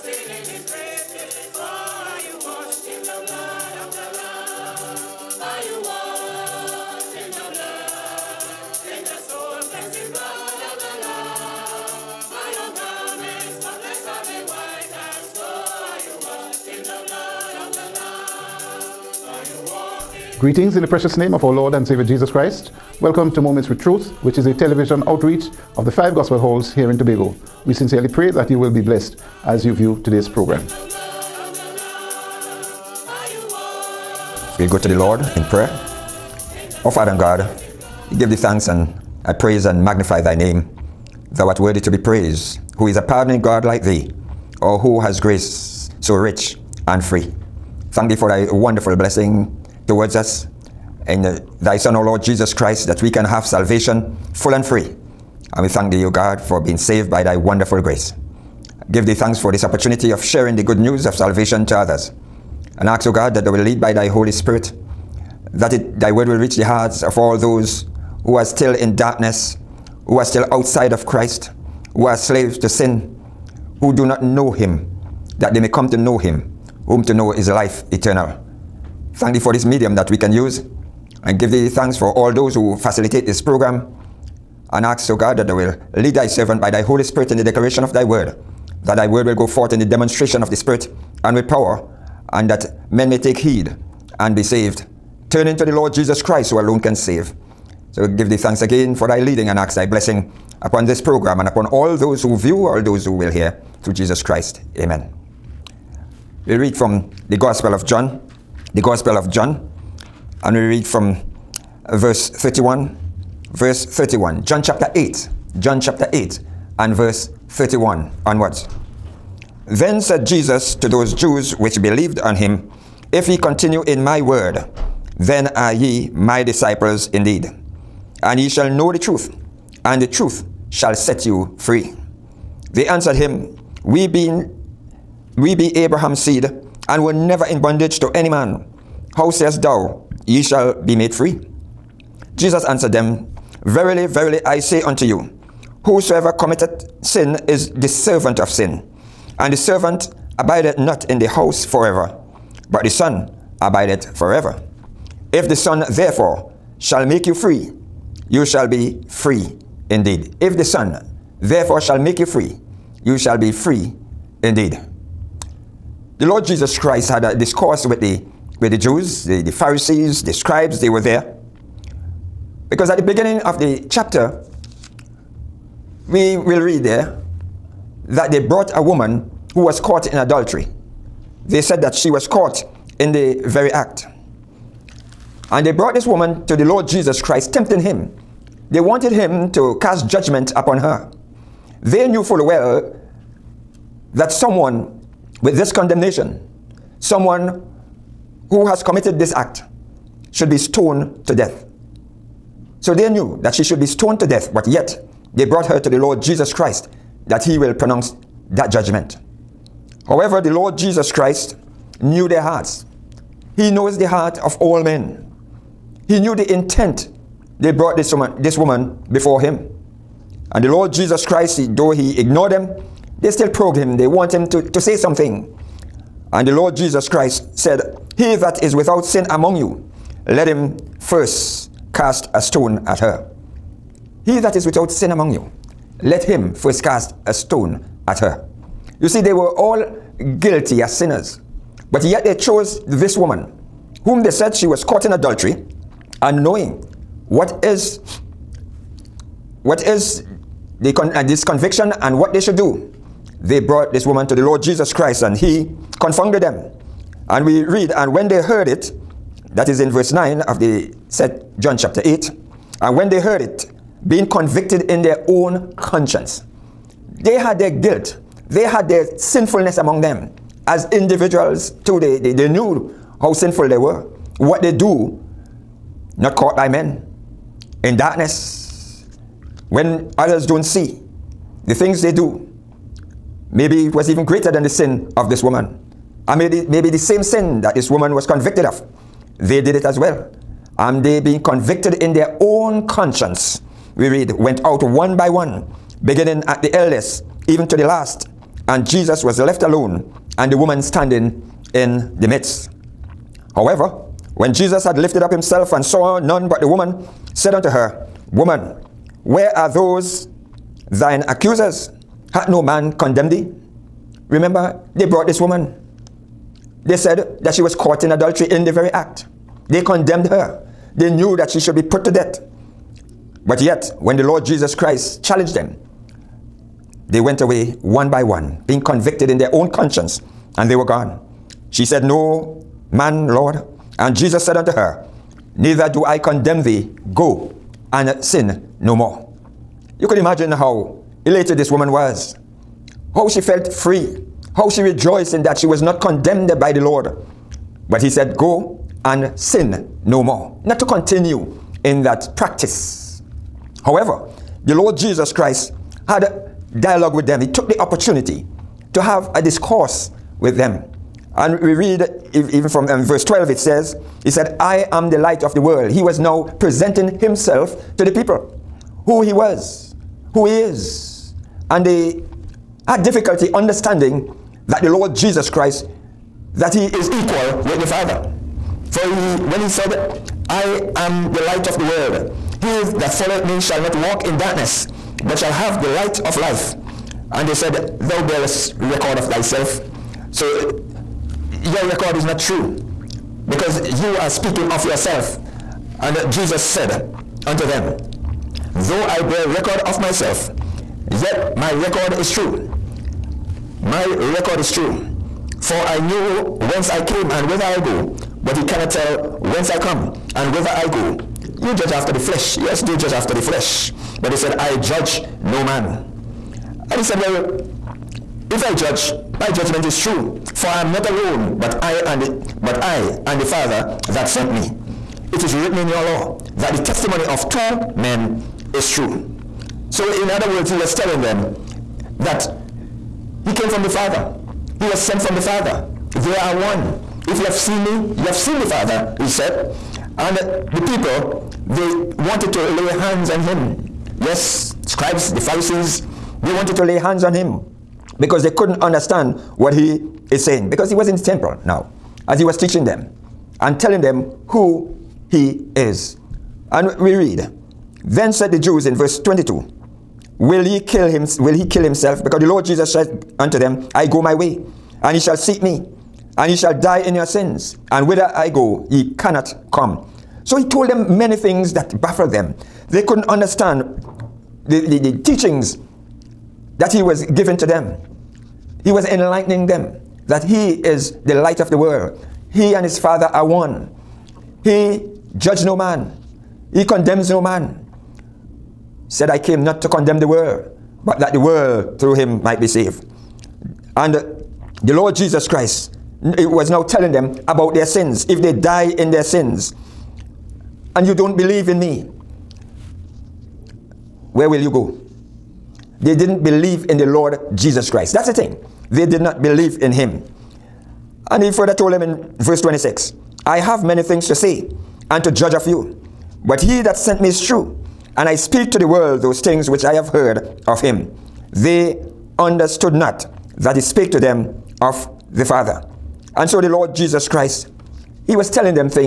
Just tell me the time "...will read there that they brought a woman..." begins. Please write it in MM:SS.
02:56.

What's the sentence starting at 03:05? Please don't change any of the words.
And they brought this woman to the Lord Jesus Christ, tempting him.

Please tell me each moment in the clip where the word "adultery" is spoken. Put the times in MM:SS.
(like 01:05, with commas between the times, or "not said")
03:00, 04:05, 05:18.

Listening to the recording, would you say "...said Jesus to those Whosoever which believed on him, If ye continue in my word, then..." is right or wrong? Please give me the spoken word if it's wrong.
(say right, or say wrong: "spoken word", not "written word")
wrong: "Jews", not "Whosoever".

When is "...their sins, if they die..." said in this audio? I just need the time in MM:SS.
08:17.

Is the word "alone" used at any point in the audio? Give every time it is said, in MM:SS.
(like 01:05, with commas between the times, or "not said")
01:36, 04:59, 07:01.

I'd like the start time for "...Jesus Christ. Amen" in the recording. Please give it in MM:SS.
01:43.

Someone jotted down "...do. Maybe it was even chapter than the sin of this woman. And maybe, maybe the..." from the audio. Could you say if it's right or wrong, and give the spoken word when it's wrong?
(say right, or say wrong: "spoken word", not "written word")
wrong: "greater", not "chapter".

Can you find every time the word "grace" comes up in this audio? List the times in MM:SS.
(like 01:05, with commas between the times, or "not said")
00:45, 00:57.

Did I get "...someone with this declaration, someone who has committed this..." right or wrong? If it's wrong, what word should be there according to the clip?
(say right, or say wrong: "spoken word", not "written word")
wrong: "condemnation", not "declaration".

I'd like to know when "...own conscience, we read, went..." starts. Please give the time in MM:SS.
04:52.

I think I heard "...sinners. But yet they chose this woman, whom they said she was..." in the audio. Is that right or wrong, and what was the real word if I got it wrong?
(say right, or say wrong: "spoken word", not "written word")
right.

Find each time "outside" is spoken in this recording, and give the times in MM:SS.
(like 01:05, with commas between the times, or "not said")
01:10.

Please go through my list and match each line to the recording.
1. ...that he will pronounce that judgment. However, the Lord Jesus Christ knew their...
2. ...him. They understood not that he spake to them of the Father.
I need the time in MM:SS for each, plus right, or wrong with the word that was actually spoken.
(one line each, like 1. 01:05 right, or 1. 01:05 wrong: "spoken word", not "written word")
1. 03:27 right
2. 08:40 right.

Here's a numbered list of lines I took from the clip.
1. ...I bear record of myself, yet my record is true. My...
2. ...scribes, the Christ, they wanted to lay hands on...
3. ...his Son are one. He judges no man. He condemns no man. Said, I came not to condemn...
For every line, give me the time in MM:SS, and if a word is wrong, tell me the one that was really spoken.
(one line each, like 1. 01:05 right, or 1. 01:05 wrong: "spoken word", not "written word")
1. 06:39 right
2. 07:24 wrong: "Pharisees", not "Christ"
3. 08:02 wrong: "Father", not "Son".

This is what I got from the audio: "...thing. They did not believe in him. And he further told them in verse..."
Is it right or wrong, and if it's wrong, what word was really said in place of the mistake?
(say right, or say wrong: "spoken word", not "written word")
right.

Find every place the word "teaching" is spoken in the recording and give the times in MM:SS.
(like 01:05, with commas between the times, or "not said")
07:32, 07:55.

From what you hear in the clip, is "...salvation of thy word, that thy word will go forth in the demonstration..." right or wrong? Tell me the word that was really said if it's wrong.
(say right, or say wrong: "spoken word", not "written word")
wrong: "declaration", not "salvation".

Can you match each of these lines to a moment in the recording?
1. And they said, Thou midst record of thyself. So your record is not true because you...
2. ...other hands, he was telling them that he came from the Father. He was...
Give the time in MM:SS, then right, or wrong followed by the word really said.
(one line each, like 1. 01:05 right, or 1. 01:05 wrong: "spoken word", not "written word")
1. 06:27 wrong: "bearest", not "midst"
2. 07:10 wrong: "words", not "hands".